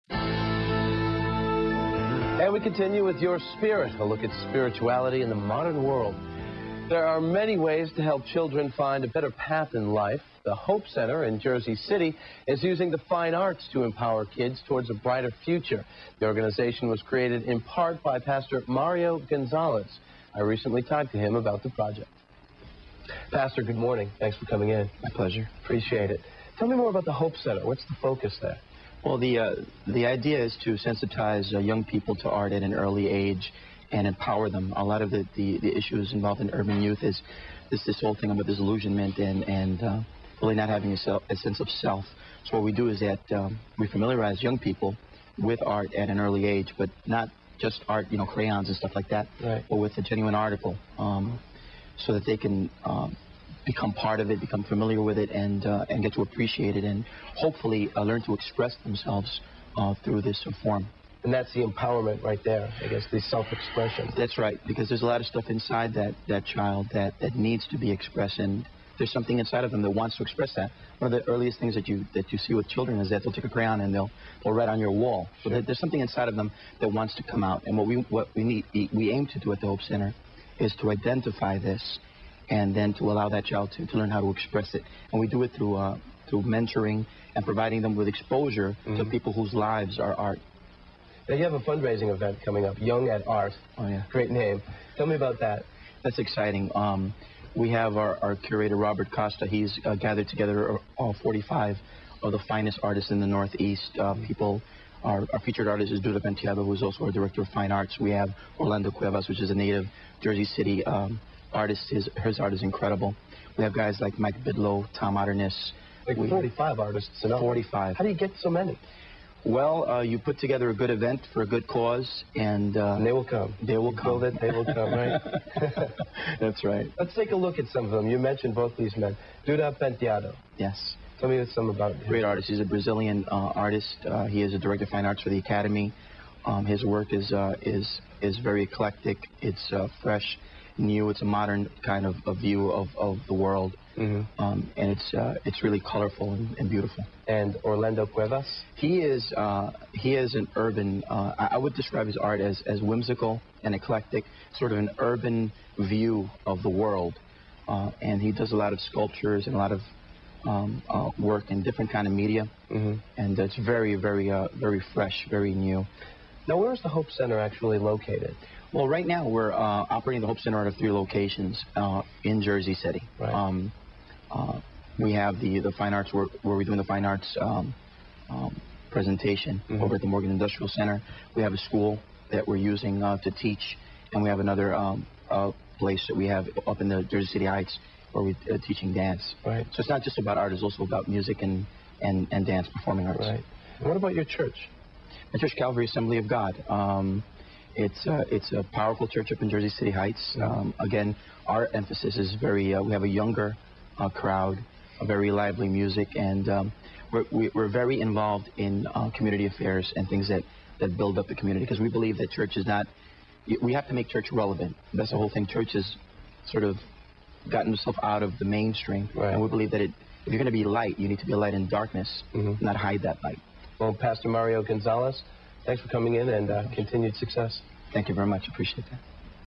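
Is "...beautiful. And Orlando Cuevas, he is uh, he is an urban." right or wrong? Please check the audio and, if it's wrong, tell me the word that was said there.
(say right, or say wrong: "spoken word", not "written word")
right.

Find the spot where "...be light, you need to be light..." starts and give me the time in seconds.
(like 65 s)
220 s.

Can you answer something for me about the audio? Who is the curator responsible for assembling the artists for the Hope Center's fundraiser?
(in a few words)
Robert Costa.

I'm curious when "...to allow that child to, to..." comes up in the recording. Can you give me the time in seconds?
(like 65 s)
82 s.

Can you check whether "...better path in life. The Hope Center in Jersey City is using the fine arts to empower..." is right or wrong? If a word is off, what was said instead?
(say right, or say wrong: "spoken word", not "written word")
right.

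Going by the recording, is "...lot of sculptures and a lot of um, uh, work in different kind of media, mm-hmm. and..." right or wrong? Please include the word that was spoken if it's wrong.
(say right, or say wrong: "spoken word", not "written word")
right.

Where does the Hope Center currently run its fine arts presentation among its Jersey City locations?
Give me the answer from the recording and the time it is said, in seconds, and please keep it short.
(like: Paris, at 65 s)
Morgan Industrial Center, at 180 s.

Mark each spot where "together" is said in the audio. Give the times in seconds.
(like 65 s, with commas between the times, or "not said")
100 s, 120 s.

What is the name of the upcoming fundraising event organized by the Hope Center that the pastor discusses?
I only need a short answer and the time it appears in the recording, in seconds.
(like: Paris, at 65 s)
Young at Art, at 92 s.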